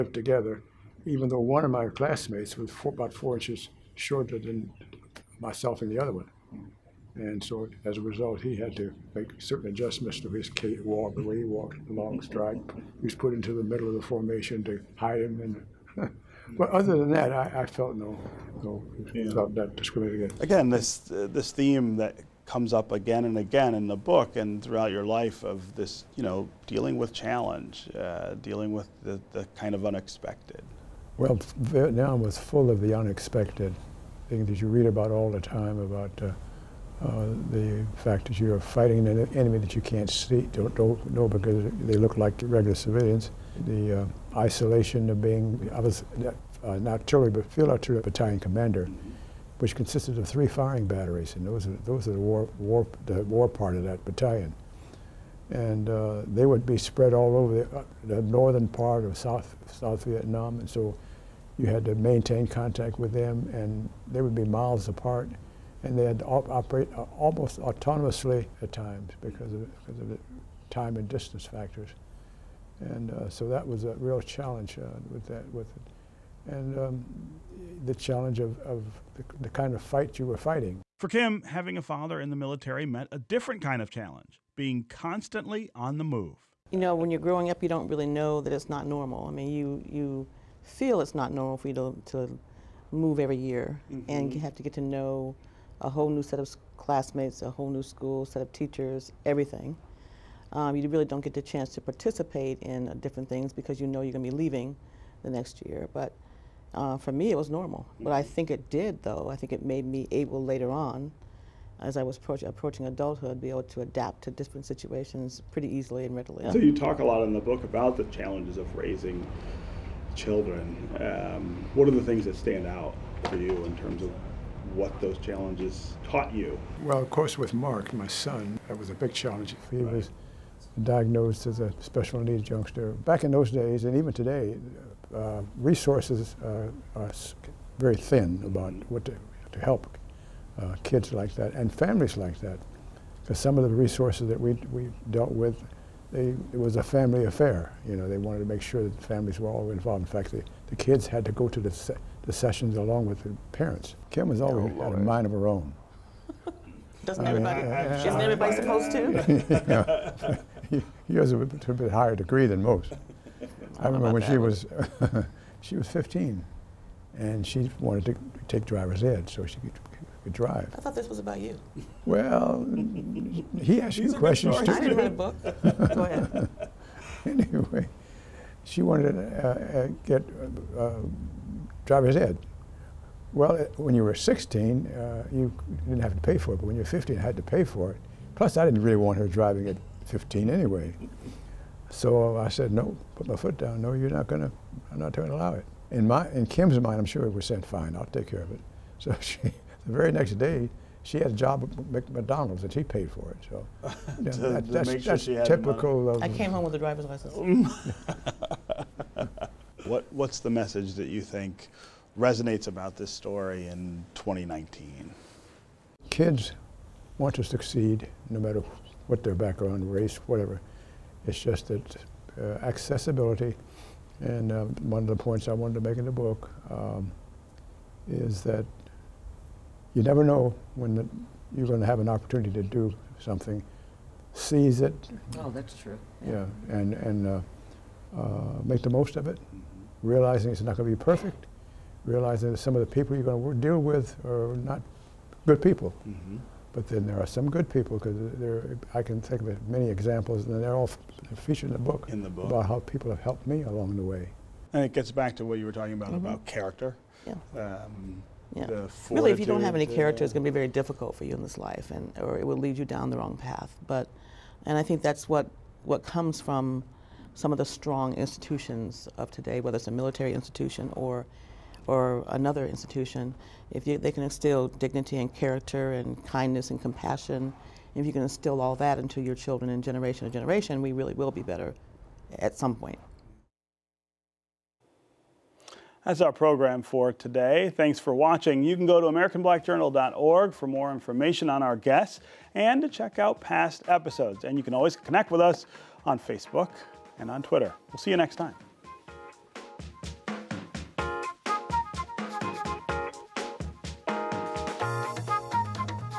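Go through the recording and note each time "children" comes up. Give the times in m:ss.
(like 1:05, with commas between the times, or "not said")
2:00, 4:39.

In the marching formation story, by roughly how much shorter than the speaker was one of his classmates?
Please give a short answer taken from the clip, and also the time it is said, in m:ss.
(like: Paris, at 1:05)
4 inches, at 0:03.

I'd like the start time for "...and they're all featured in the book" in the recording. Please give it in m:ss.
4:10.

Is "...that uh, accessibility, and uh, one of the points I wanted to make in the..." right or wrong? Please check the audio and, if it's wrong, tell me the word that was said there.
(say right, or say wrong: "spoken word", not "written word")
right.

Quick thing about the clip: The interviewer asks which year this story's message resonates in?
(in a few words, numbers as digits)
2019.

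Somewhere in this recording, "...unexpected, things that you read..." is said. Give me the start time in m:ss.
0:32.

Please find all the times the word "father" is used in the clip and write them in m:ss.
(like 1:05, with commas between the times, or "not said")
1:21.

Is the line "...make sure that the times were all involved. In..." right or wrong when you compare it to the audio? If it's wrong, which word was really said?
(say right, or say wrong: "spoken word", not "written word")
wrong: "families", not "times".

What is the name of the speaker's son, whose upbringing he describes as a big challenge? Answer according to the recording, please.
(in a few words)
Mark.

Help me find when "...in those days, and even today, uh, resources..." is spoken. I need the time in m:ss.
2:13.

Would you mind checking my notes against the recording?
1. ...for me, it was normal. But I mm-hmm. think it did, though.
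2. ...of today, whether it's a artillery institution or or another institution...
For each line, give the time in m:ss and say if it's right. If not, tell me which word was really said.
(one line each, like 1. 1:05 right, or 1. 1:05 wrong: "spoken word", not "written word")
1. 1:46 right
2. 4:29 wrong: "military", not "artillery".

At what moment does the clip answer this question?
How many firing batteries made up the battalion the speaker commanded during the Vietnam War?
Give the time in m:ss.
0:50.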